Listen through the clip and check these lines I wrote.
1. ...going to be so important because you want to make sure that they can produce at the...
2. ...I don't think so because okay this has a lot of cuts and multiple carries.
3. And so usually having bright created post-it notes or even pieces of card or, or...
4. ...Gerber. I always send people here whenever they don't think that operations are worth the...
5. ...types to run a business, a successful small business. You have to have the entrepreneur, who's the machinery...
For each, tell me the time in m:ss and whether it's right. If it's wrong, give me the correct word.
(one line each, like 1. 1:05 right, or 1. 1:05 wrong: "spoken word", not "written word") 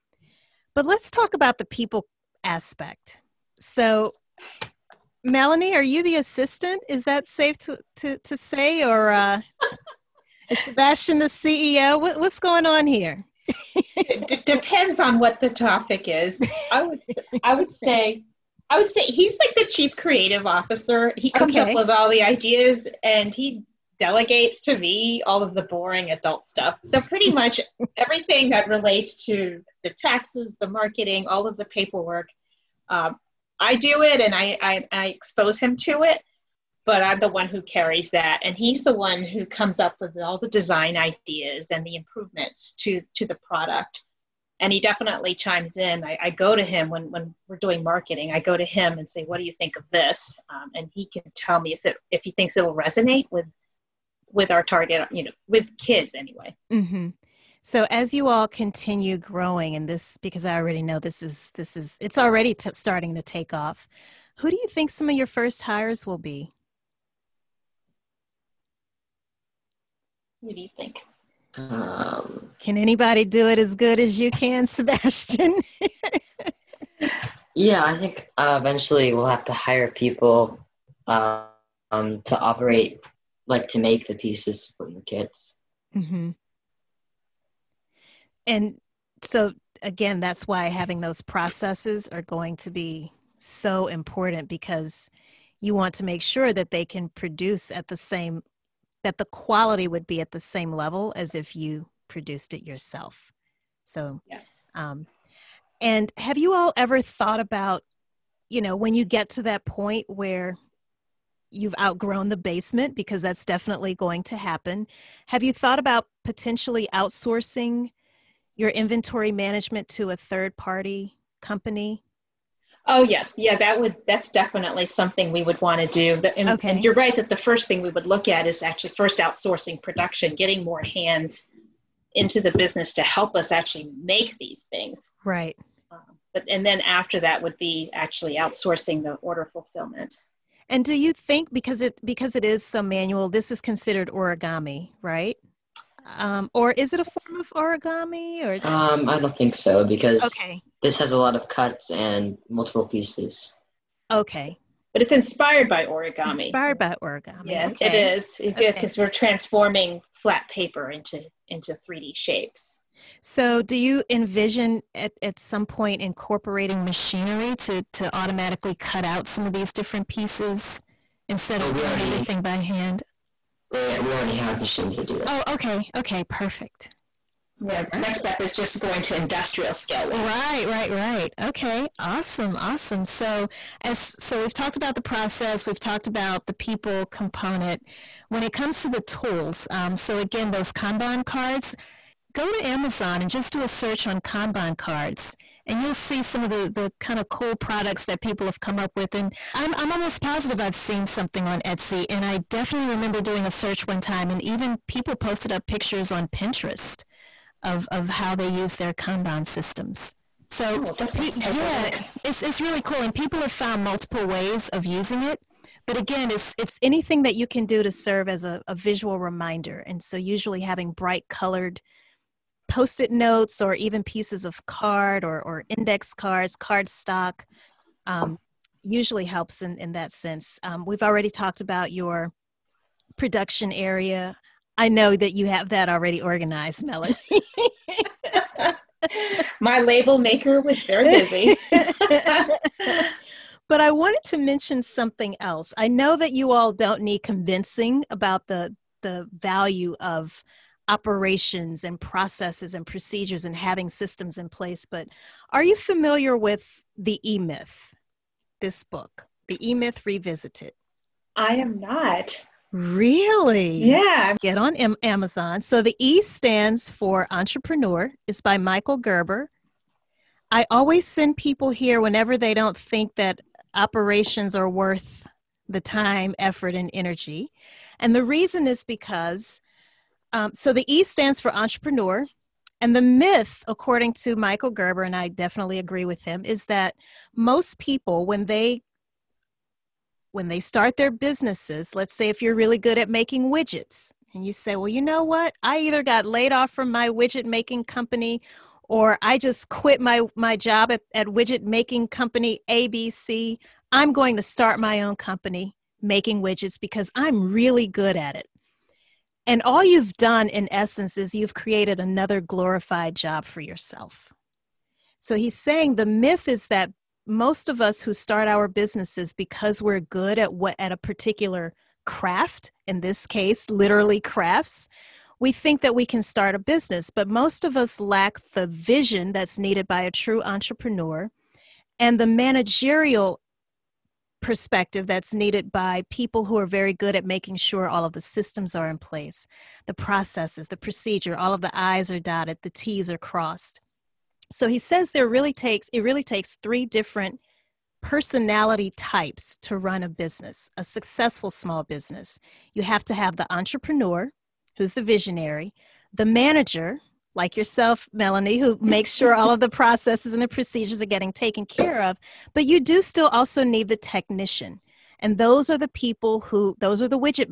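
1. 1:32 right
2. 2:29 wrong: "pieces", not "carries"
3. 3:39 wrong: "colored", not "created"
4. 4:28 right
5. 5:48 wrong: "visionary", not "machinery".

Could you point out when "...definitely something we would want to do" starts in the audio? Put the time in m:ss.
2:04.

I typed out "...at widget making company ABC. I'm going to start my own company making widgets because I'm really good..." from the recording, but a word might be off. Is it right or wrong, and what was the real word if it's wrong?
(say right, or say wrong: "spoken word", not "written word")
right.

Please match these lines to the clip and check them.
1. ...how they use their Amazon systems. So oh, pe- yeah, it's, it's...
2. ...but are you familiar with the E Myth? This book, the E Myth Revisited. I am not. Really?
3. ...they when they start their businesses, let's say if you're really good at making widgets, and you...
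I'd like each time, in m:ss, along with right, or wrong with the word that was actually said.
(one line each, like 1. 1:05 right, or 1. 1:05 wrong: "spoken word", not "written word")
1. 3:28 wrong: "Kanban", not "Amazon"
2. 4:14 right
3. 4:48 right.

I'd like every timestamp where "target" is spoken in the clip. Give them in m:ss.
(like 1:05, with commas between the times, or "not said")
0:54.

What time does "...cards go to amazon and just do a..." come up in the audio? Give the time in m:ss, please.
3:11.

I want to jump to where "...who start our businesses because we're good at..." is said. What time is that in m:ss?
5:18.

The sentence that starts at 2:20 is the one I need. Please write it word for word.
And do you think because it because it is so manual, this is considered origami, right?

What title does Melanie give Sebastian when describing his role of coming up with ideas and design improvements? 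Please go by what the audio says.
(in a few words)
chief creative officer.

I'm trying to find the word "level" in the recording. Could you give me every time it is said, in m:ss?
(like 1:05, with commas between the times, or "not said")
1:40.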